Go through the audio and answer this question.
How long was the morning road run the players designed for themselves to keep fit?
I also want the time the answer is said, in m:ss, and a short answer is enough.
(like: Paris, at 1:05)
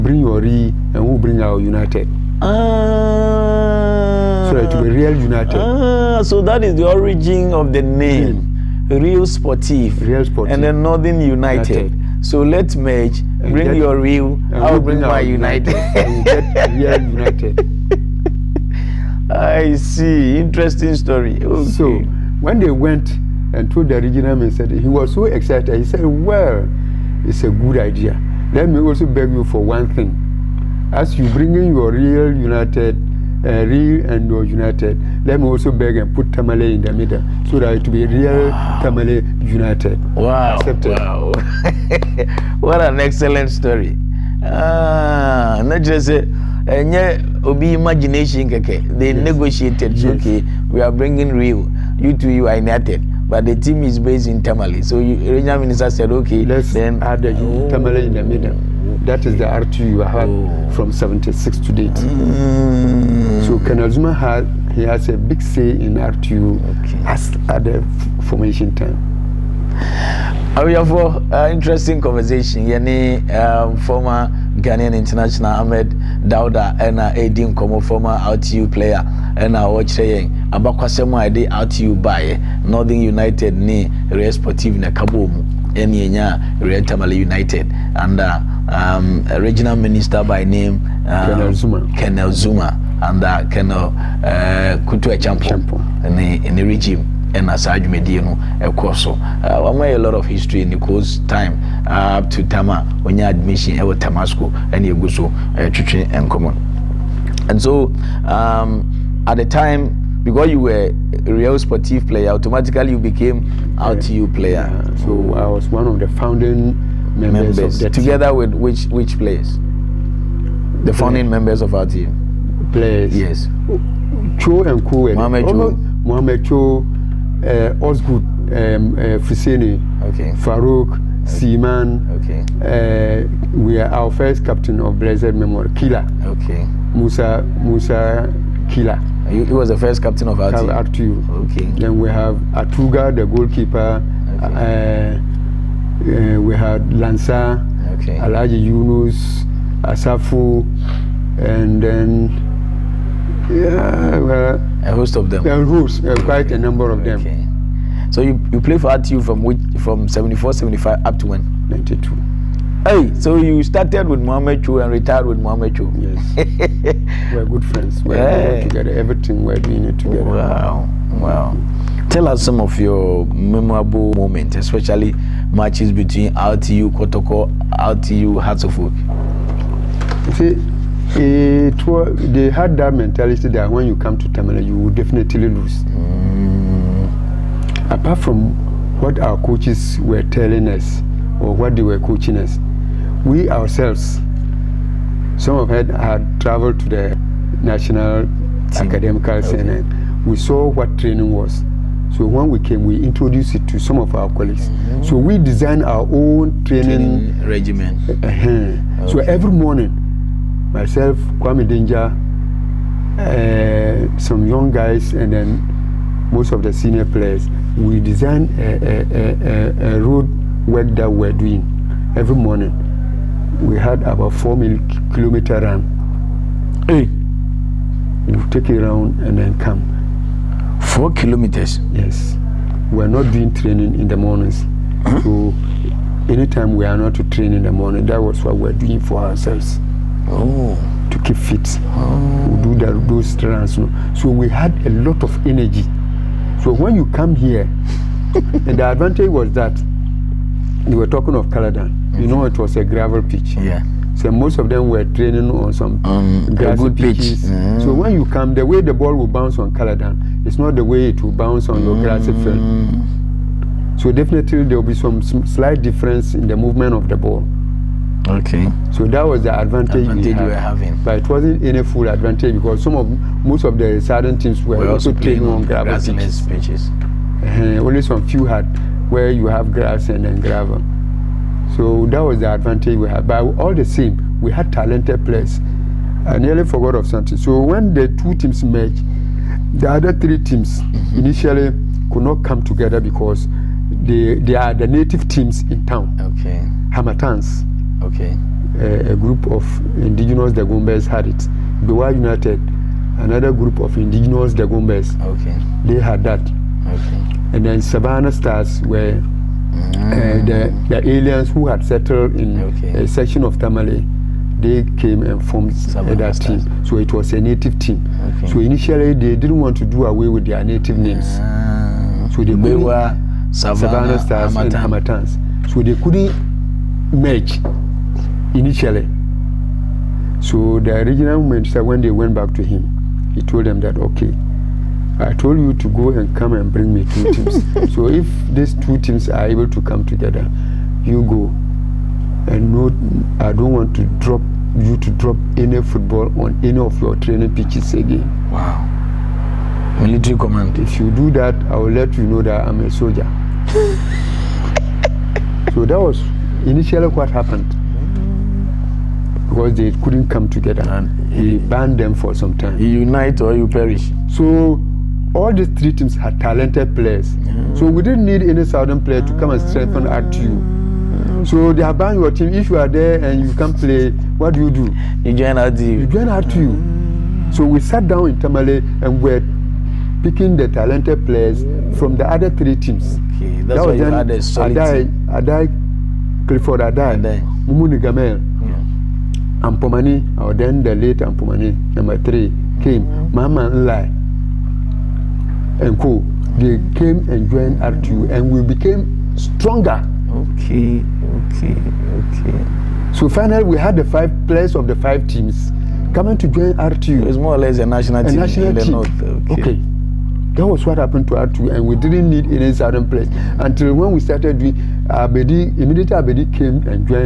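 4 kilometers, at 3:44.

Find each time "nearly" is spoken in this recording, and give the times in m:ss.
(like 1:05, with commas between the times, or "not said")
4:46.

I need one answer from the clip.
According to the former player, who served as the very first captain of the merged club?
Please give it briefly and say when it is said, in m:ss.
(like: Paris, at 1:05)
Musa Killer, at 2:16.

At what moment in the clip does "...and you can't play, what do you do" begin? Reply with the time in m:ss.
6:13.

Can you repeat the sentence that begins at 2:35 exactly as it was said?
A host, uh, quite a number of okay.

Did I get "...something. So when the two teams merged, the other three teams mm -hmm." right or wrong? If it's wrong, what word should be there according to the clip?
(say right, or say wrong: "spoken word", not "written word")
right.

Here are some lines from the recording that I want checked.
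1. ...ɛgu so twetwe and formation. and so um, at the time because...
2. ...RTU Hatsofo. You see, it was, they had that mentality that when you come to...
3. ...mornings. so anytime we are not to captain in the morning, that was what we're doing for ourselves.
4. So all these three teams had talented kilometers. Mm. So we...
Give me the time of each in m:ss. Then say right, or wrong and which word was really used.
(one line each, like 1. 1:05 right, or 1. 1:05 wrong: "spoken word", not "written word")
1. 1:44 wrong: "common", not "formation"
2. 2:57 right
3. 3:54 wrong: "train", not "captain"
4. 6:04 wrong: "players", not "kilometers".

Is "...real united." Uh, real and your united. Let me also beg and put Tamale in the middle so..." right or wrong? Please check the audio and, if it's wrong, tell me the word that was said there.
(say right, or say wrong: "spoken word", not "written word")
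right.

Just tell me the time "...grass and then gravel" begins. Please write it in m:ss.
4:39.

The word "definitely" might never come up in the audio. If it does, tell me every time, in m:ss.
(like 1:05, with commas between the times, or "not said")
3:04, 4:24.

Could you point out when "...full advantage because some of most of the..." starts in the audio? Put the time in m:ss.
4:31.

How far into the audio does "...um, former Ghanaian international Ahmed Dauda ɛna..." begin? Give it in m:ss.
1:13.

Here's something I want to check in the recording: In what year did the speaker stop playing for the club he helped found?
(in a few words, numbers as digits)
1992.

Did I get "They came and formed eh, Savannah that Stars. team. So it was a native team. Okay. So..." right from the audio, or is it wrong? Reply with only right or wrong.
right.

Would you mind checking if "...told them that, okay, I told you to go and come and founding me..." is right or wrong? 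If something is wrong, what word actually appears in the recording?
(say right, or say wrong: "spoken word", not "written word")
wrong: "bring", not "founding".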